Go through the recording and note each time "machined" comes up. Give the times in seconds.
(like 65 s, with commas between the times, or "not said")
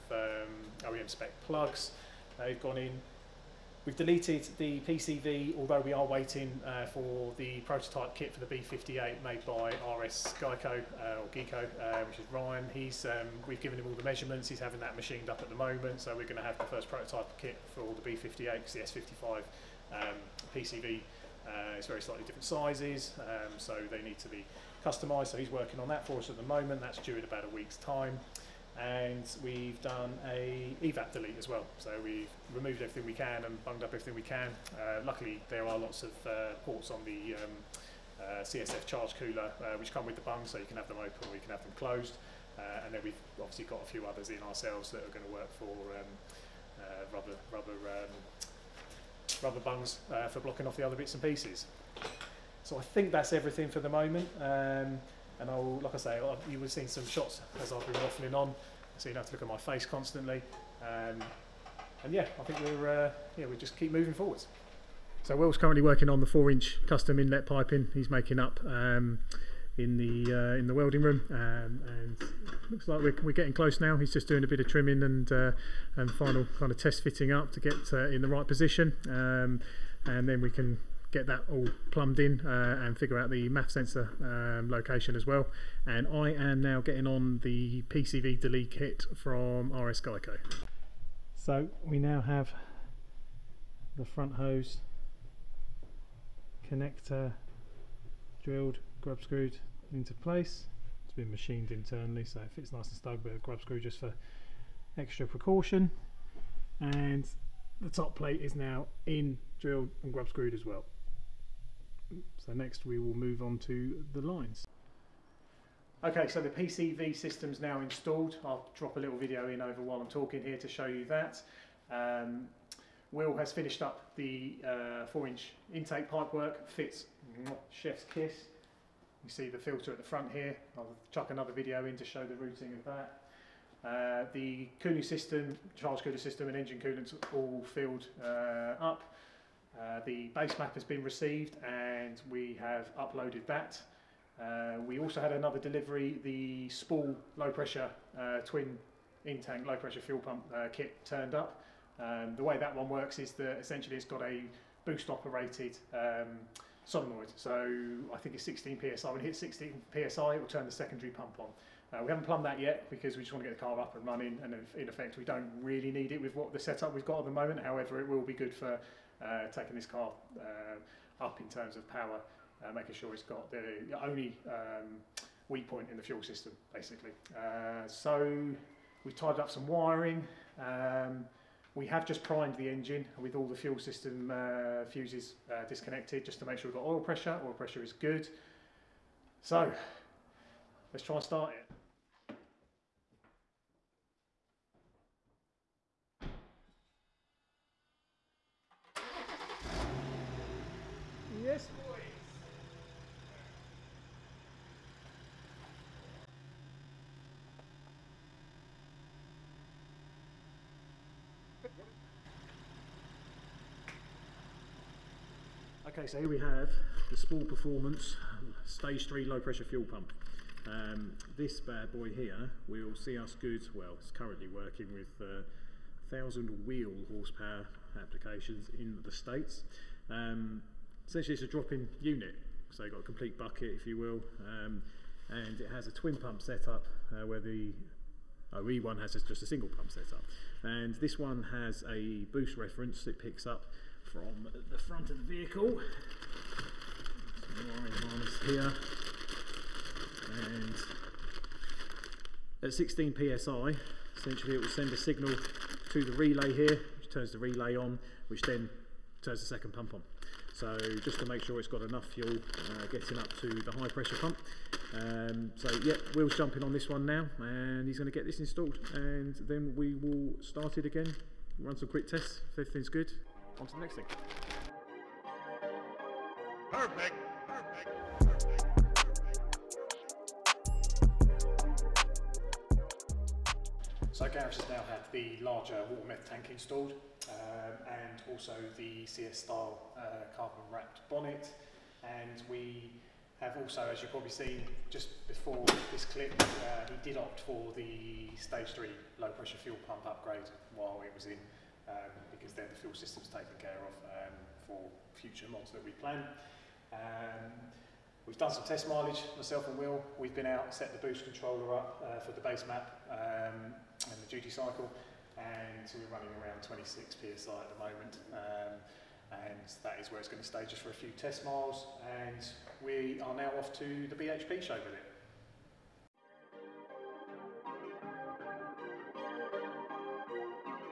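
14 s, 101 s.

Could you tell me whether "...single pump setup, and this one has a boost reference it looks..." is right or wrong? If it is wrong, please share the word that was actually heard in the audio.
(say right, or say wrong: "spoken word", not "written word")
wrong: "picks", not "looks".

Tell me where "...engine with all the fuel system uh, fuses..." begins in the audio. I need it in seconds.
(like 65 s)
182 s.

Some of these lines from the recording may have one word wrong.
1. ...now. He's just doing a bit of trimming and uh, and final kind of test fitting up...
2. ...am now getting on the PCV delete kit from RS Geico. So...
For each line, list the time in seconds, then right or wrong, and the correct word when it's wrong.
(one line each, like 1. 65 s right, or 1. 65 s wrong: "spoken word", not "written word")
1. 73 s right
2. 86 s right.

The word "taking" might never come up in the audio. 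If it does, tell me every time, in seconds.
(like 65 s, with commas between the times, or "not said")
169 s.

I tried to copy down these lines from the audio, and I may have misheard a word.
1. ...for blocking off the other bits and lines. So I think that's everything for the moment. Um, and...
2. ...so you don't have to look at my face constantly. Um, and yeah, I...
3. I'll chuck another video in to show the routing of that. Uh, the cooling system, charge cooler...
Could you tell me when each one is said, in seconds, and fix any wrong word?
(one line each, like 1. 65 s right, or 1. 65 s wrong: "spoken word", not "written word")
1. 50 s wrong: "pieces", not "lines"
2. 58 s right
3. 130 s right.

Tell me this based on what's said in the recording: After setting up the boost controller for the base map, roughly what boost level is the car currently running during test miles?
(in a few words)
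26 psi.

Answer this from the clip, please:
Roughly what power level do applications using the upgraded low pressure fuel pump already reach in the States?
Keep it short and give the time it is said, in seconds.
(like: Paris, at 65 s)
1000 wheel horsepower, at 226 s.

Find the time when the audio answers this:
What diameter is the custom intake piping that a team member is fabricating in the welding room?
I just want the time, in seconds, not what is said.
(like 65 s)
66 s.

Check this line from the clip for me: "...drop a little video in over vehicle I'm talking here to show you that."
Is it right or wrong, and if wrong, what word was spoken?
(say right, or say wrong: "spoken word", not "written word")
wrong: "while", not "vehicle".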